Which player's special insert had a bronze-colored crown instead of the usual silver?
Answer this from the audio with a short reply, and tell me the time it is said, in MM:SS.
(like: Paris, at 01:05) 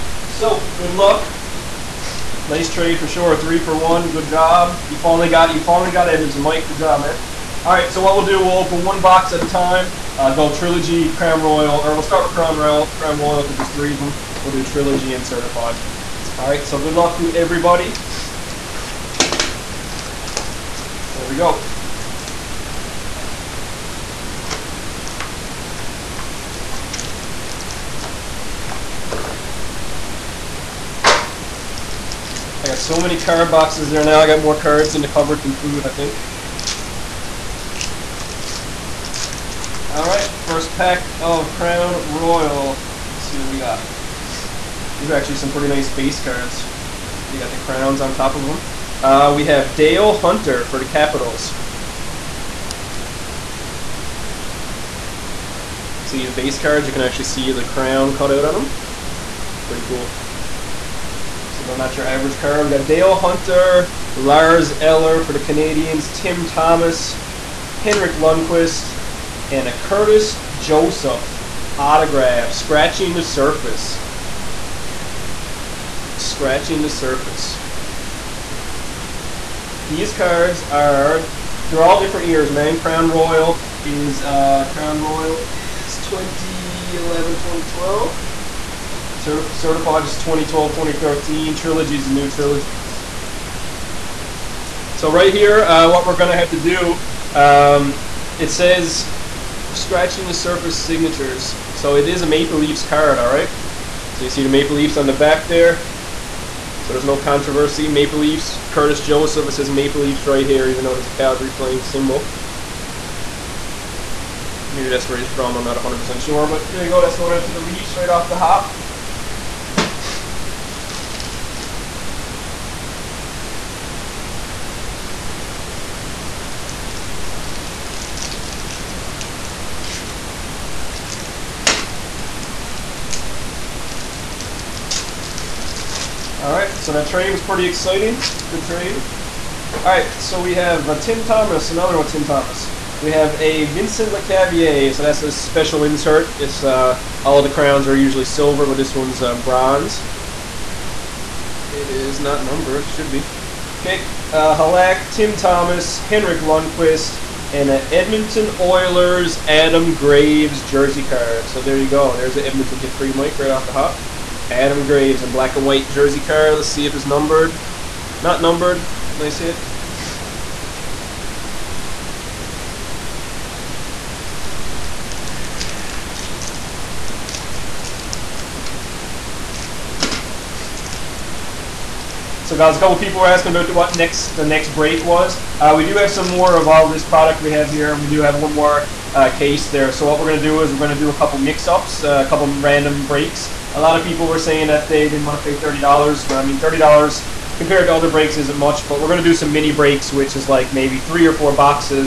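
Vincent Lecavalier, at 02:23.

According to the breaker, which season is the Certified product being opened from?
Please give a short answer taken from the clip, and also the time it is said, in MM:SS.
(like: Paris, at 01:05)
2012, 2013, at 01:29.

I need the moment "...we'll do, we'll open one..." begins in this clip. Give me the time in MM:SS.
00:08.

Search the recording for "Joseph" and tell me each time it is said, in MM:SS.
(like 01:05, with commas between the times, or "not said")
01:10, 01:49.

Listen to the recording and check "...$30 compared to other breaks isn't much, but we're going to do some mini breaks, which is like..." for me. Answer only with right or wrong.
right.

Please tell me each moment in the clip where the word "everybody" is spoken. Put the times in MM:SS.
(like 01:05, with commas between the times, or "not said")
00:17.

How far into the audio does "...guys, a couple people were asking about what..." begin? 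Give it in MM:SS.
03:02.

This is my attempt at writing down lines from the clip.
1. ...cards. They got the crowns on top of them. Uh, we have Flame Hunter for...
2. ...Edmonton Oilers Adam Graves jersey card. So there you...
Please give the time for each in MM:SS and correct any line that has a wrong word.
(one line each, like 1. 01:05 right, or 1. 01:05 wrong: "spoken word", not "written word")
1. 00:46 wrong: "Dale", not "Flame"
2. 02:37 right.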